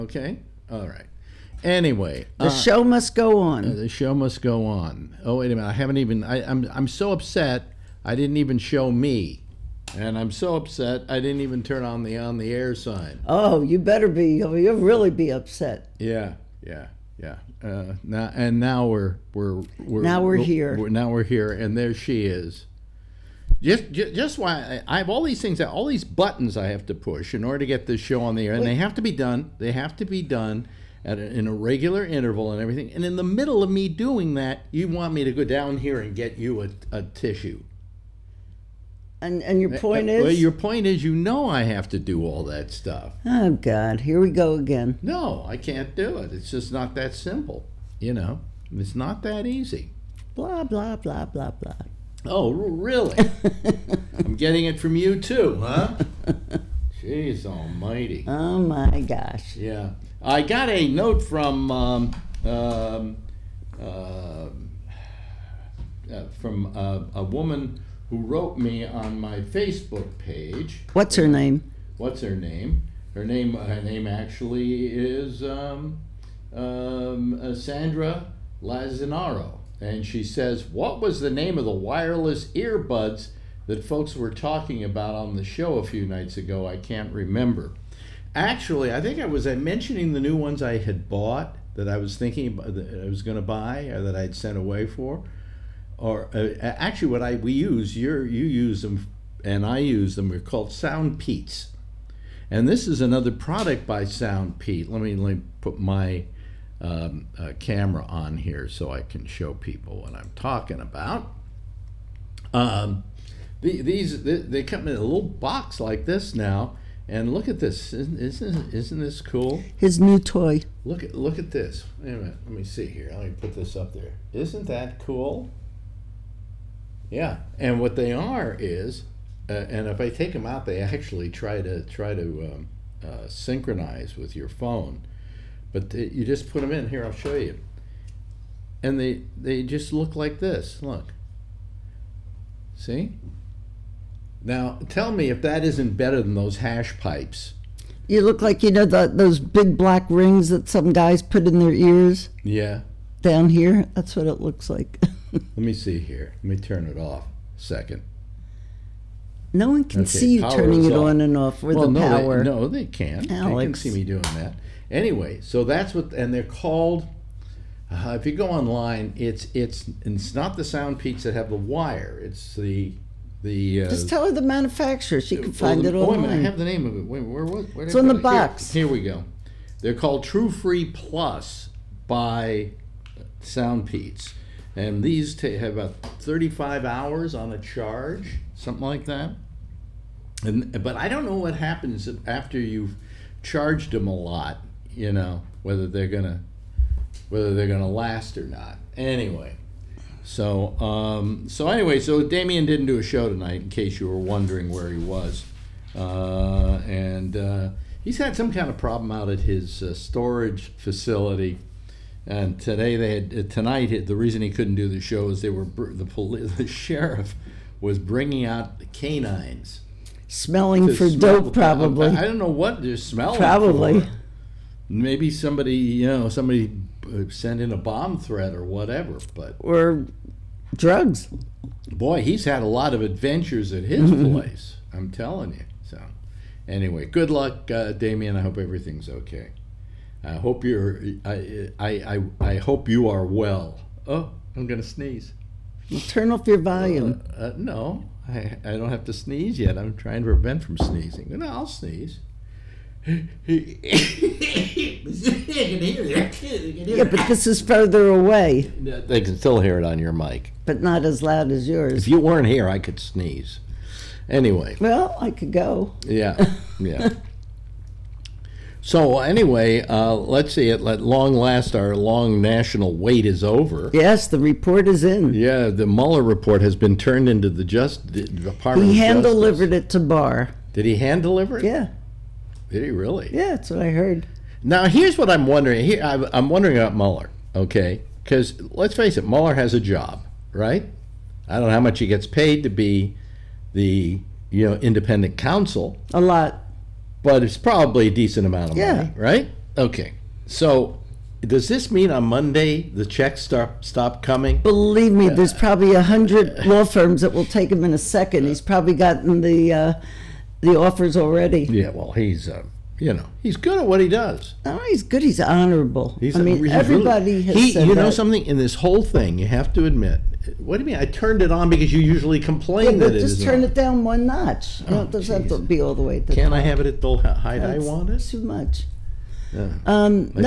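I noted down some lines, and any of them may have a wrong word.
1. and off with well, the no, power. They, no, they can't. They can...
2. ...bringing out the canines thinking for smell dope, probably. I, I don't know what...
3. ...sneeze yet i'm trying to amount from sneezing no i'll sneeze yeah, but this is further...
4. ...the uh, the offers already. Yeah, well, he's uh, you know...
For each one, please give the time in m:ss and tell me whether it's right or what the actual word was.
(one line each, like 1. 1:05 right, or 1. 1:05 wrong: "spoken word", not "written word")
1. 2:41 right
2. 3:37 wrong: "smelling", not "thinking"
3. 4:09 wrong: "prevent", not "amount"
4. 5:09 right.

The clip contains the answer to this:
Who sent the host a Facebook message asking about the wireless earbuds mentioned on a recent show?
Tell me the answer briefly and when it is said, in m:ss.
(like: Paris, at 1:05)
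Sandra Lazinaro, at 1:17.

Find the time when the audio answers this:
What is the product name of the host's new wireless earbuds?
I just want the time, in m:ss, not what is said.
3:00.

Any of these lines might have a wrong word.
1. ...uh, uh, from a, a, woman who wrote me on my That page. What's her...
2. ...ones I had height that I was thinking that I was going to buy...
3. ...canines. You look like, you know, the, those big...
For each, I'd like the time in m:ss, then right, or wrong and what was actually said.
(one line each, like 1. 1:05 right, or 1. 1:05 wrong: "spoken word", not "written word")
1. 1:03 wrong: "Facebook", not "That"
2. 1:30 wrong: "bought", not "height"
3. 2:26 wrong: "pipes", not "canines".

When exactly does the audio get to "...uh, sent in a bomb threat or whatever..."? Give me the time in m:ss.
3:47.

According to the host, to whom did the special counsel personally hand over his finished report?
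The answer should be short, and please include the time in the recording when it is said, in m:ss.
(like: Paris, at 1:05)
Barr, at 4:39.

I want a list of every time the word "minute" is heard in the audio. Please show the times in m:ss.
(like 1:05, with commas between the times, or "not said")
0:05, 2:02.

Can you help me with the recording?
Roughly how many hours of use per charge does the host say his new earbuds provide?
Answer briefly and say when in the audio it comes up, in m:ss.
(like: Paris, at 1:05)
35, at 3:06.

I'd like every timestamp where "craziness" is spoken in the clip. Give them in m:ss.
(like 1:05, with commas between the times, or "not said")
not said.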